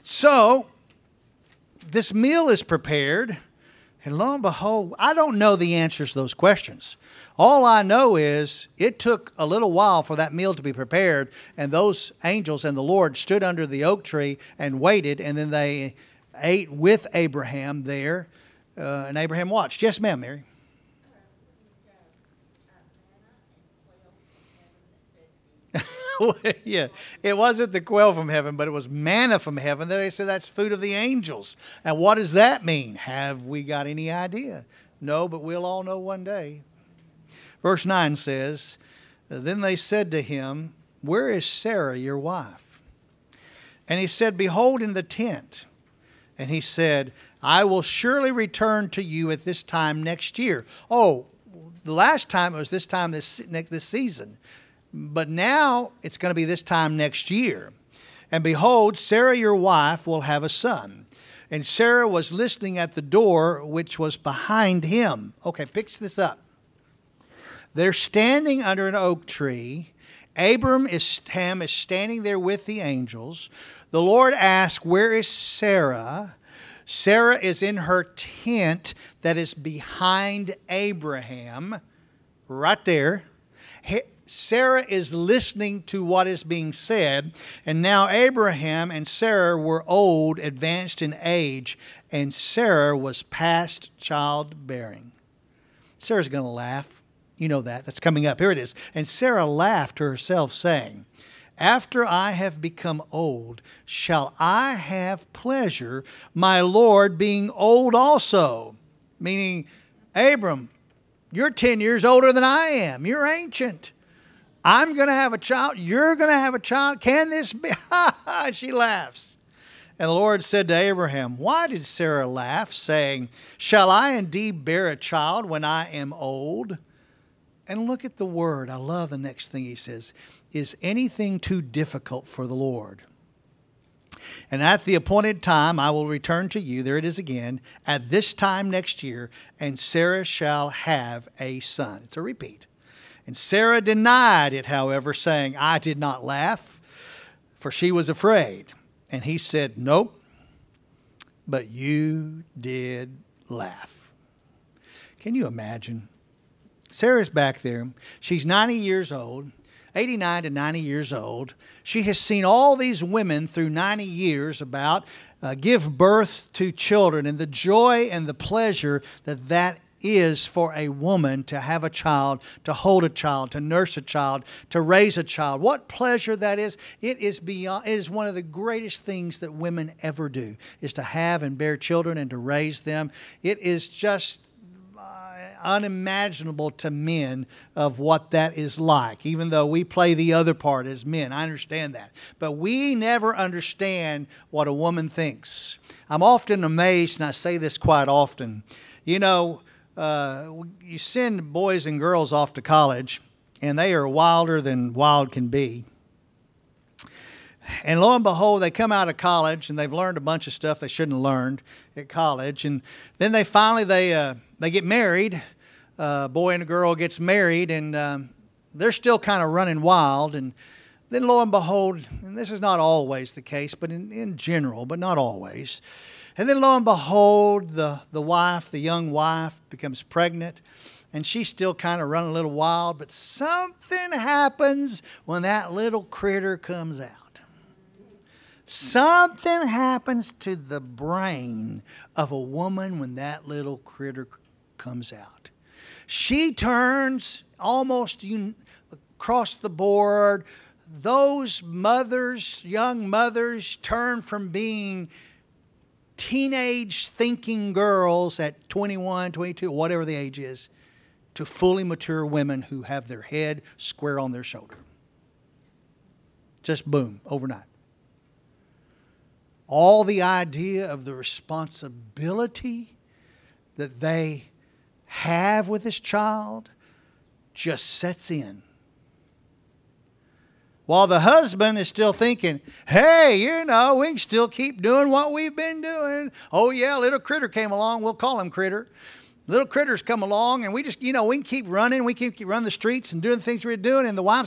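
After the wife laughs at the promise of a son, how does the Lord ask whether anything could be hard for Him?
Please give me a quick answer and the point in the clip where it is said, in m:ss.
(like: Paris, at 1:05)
Too difficult, at 2:11.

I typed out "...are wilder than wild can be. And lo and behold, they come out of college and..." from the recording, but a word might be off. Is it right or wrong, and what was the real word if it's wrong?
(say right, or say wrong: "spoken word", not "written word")
right.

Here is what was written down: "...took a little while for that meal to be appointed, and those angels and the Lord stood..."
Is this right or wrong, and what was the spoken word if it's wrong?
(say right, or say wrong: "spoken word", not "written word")
wrong: "prepared", not "appointed".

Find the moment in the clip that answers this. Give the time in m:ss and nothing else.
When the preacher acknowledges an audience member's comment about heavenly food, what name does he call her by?
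0:20.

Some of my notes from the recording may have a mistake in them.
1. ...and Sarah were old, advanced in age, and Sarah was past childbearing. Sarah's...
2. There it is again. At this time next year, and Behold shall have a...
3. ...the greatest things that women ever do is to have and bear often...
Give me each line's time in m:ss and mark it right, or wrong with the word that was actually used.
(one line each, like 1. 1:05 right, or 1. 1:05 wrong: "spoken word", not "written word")
1. 1:28 right
2. 2:16 wrong: "Sarah", not "Behold"
3. 2:58 wrong: "children", not "often".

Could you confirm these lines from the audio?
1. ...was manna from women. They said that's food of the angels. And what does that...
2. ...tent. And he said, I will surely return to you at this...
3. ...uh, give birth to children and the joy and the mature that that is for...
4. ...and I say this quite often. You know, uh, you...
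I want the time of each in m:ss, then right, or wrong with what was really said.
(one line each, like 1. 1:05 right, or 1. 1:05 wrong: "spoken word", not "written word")
1. 0:28 wrong: "heaven", not "women"
2. 0:45 right
3. 2:45 wrong: "pleasure", not "mature"
4. 3:17 right.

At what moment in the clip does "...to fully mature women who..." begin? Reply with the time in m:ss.
4:21.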